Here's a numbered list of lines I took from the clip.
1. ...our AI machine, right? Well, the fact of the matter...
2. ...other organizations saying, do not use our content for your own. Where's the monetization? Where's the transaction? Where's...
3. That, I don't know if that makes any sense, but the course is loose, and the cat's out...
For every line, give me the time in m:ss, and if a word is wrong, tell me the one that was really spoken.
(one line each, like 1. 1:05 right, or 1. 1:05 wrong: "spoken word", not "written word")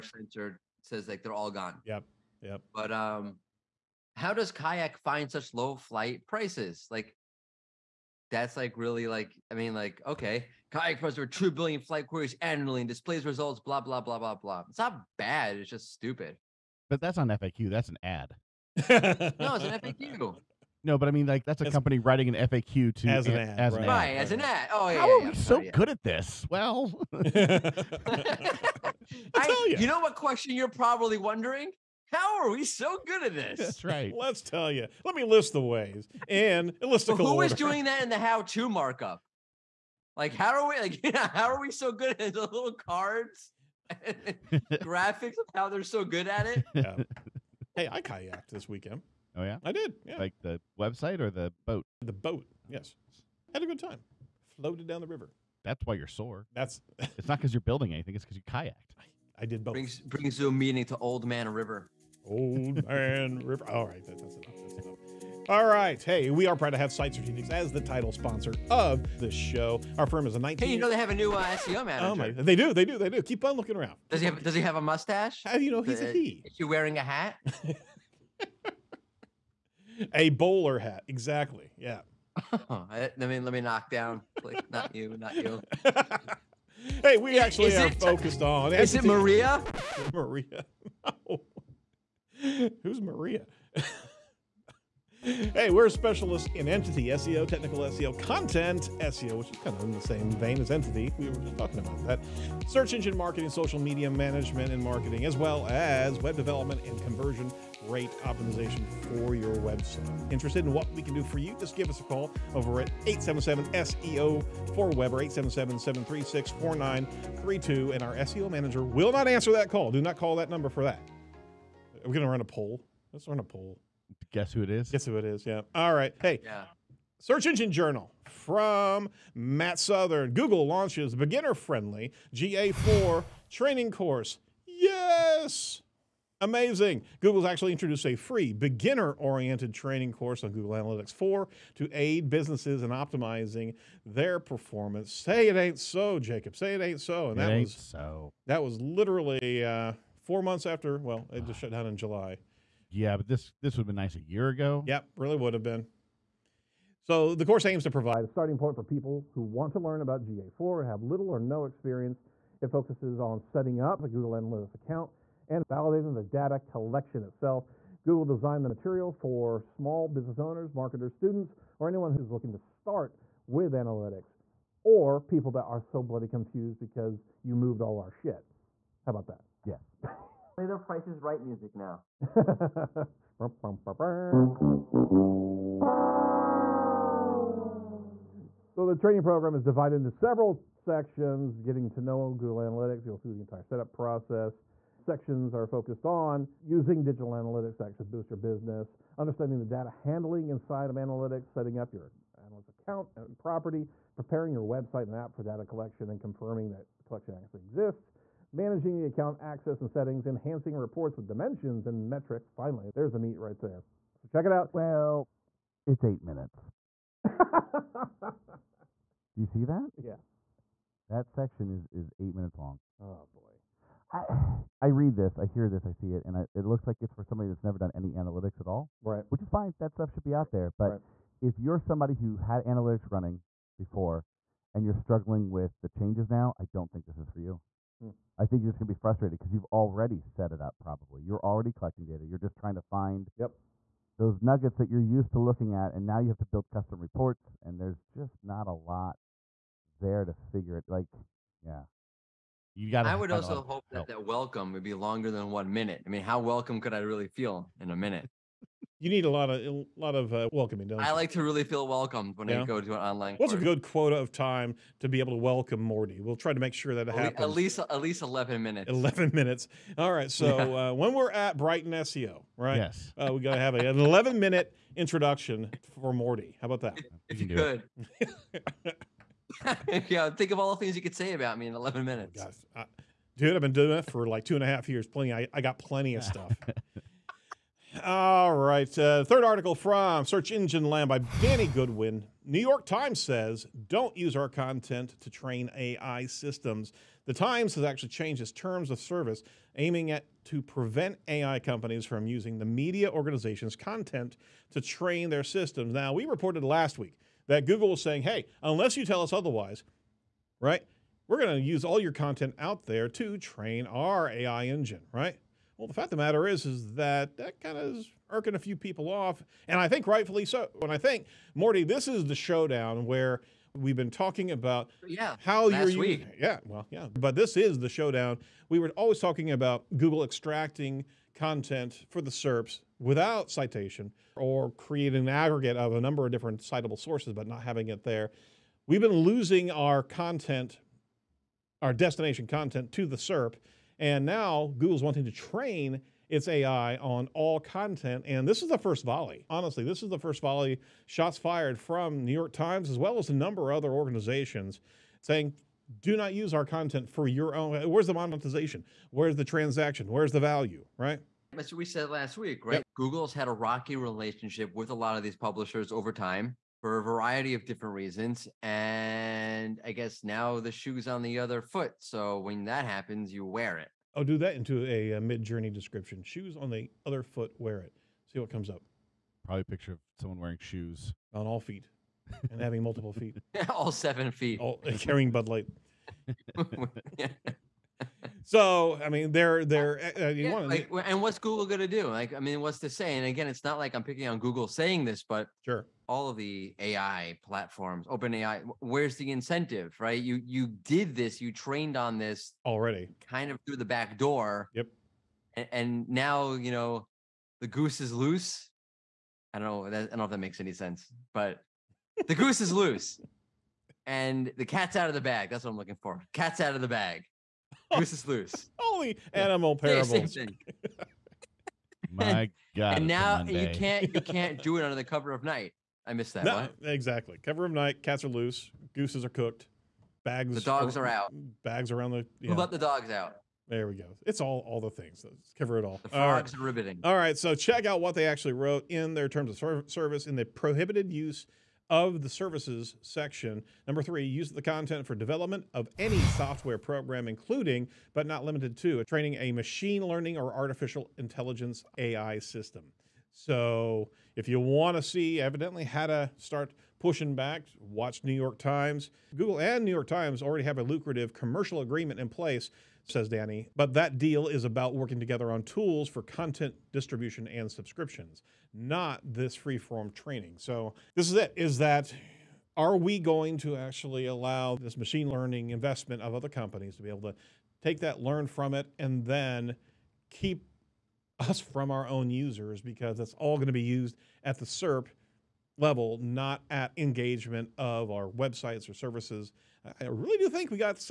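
1. 5:13 wrong: "engine", not "machine"
2. 5:53 right
3. 6:49 wrong: "goose", not "course".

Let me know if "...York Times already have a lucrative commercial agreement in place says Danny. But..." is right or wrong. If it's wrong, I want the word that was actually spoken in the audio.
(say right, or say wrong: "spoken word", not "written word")
right.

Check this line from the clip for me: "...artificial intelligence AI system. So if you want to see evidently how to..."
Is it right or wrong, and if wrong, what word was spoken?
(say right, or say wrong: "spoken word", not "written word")
right.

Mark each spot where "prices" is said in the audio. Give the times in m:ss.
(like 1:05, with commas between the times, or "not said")
0:06, 0:10, 3:00.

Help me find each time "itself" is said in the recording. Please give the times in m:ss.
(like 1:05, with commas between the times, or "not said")
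2:47.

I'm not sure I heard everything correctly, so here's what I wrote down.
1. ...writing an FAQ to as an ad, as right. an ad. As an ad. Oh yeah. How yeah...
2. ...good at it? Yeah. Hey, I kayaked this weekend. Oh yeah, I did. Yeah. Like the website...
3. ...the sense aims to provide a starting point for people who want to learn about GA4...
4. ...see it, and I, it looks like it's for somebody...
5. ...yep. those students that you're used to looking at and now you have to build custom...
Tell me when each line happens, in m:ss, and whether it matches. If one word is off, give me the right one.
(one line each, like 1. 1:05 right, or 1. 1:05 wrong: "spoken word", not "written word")
1. 0:21 right
2. 0:46 right
3. 2:37 wrong: "course", not "sense"
4. 3:45 right
5. 4:03 wrong: "nuggets", not "students".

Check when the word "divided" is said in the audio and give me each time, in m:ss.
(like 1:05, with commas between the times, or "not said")
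3:09.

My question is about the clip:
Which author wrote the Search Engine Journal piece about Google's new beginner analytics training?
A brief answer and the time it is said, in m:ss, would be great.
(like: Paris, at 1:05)
Matt Southern, at 2:09.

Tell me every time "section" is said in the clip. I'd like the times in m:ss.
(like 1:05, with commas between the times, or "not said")
3:10, 3:14, 3:41, 7:23.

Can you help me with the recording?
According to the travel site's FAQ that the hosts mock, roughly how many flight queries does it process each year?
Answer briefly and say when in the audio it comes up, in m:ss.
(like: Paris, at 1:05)
2 billion, at 0:11.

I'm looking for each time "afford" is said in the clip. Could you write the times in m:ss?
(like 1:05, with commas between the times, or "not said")
not said.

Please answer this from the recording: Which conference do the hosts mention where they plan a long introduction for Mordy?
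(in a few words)
BrightonSEO.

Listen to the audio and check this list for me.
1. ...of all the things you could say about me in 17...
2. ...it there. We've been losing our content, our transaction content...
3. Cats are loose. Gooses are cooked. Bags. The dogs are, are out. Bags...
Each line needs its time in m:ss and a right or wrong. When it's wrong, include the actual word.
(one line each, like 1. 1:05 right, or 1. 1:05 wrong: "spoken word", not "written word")
1. 4:40 wrong: "11", not "17"
2. 5:37 wrong: "destination", not "transaction"
3. 7:08 right.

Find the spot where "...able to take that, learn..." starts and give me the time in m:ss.
7:57.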